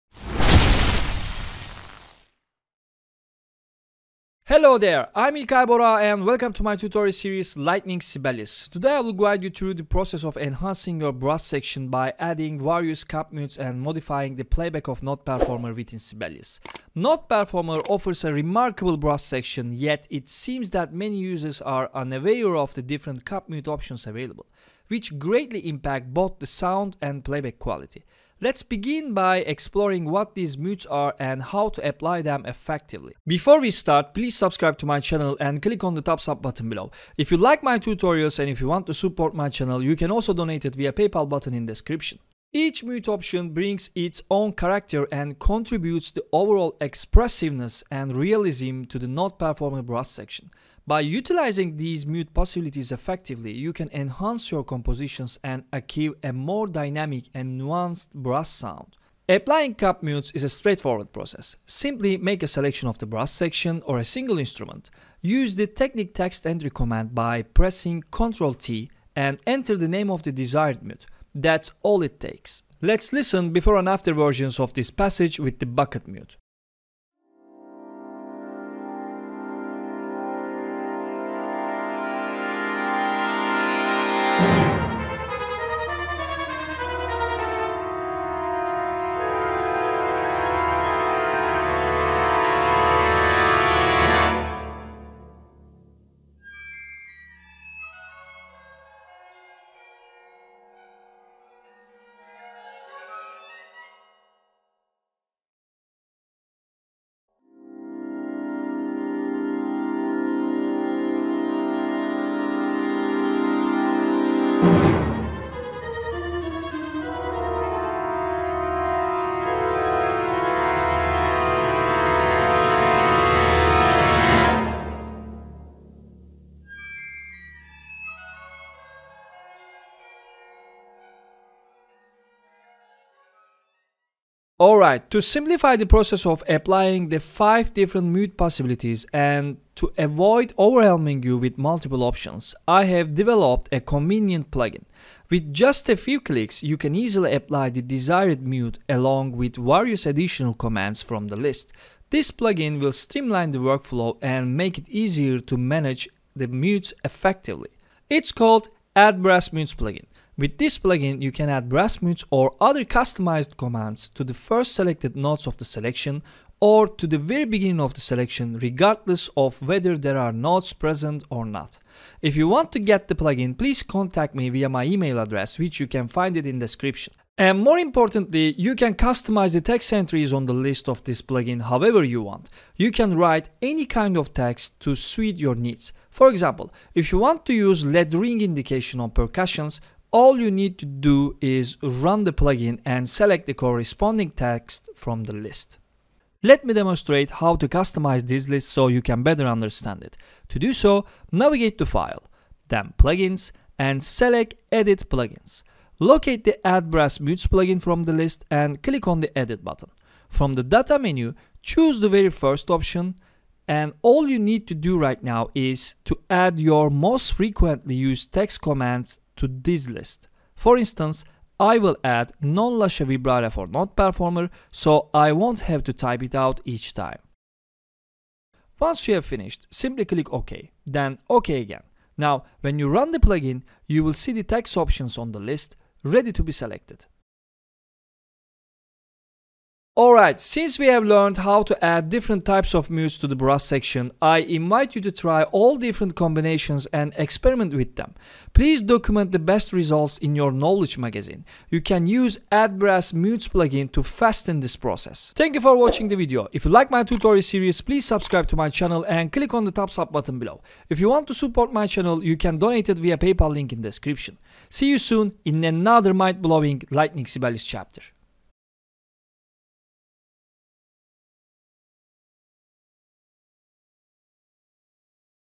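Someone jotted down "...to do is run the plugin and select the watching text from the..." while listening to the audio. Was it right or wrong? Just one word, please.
wrong.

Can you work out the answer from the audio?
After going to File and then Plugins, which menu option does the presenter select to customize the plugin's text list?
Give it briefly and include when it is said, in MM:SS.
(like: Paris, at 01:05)
Edit Plugins, at 03:24.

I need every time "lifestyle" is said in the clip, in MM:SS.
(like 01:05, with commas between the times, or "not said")
not said.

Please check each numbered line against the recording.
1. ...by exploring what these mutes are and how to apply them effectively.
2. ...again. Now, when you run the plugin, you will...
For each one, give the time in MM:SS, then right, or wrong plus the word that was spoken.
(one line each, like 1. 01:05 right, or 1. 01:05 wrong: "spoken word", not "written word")
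1. 00:29 right
2. 03:51 right.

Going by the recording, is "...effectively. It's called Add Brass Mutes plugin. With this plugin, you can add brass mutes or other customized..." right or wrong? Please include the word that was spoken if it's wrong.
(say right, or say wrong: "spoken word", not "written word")
right.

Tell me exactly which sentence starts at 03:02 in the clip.
You can write any kind of text to suit your needs.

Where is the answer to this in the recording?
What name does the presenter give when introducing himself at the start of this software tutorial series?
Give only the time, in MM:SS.
00:05.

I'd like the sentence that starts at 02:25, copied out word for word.
With just a few clicks, you can easily apply the desired mute along with various additional commands from the list.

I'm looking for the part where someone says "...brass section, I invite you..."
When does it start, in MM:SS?
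04:03.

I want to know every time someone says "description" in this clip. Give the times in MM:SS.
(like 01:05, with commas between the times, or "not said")
00:41, 02:56, 04:23.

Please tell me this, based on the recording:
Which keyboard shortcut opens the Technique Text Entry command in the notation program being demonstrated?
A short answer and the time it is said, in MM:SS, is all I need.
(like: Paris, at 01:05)
Ctrl T, at 01:08.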